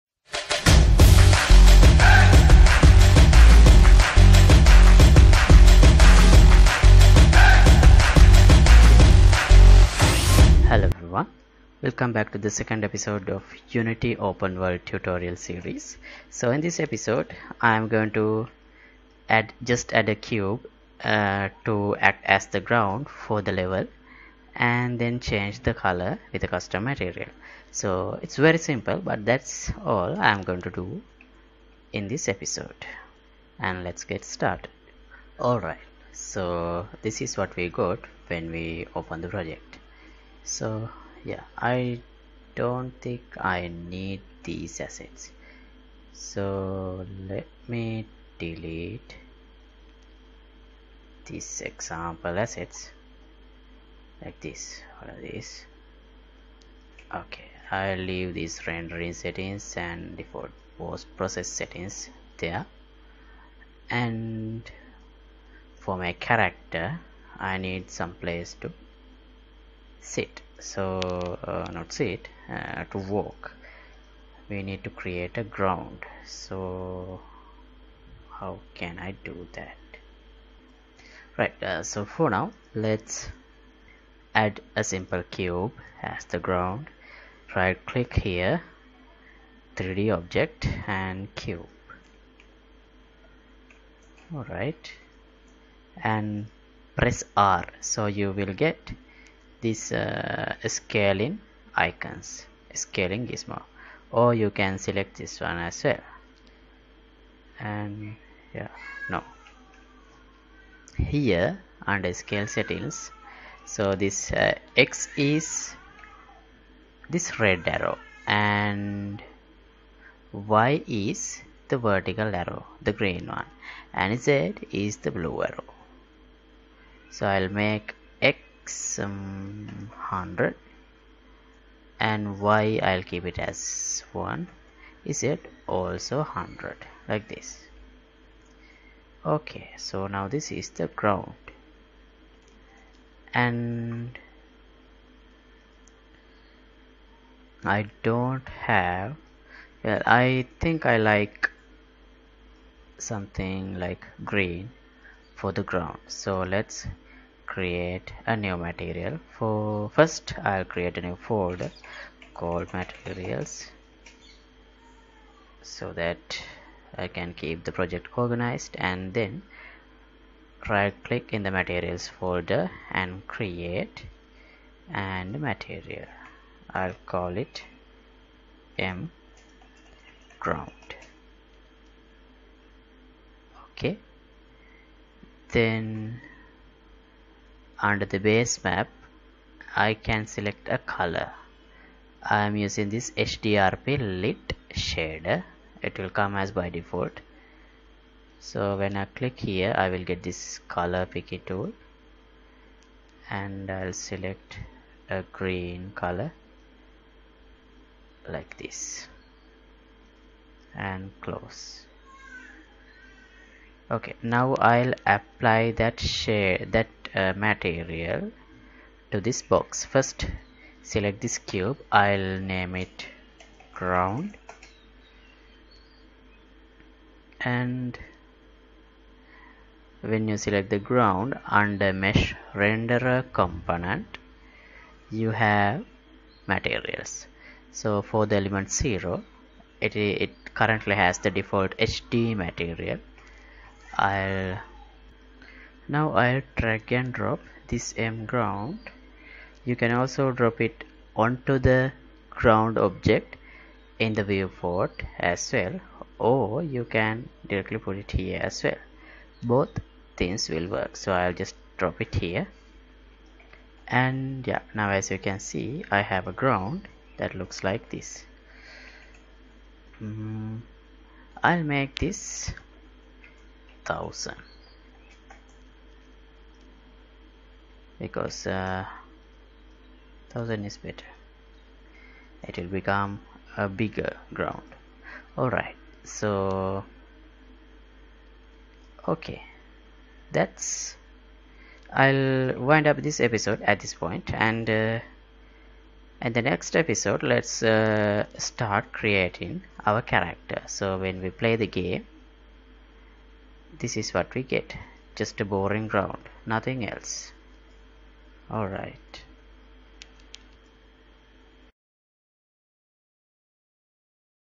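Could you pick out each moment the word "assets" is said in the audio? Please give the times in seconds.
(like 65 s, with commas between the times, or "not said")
44 s, 52 s.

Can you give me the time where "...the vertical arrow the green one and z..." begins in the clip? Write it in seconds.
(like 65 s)
121 s.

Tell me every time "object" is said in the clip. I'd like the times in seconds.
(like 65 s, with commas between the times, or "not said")
90 s, 252 s.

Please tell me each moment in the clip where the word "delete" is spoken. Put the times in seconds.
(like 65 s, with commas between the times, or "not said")
48 s.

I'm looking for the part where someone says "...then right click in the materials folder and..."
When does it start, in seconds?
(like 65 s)
169 s.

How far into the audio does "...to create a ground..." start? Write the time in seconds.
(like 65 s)
74 s.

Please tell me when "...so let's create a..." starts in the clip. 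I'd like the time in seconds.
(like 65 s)
156 s.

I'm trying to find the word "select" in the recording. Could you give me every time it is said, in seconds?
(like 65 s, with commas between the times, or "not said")
104 s, 190 s, 203 s, 220 s, 230 s.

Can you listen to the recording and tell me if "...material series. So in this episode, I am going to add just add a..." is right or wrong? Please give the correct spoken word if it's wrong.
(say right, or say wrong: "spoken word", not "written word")
wrong: "tutorial", not "material".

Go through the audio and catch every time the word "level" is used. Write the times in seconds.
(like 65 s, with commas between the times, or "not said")
23 s.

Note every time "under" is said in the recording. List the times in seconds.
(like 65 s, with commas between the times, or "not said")
111 s, 187 s, 231 s.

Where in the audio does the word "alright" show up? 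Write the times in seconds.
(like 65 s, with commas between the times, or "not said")
35 s, 94 s, 285 s, 308 s.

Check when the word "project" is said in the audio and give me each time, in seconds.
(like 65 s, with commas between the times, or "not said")
39 s, 167 s.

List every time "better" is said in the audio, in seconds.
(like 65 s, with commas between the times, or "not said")
280 s.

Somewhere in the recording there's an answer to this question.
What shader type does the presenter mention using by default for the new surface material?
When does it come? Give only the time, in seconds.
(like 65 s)
193 s.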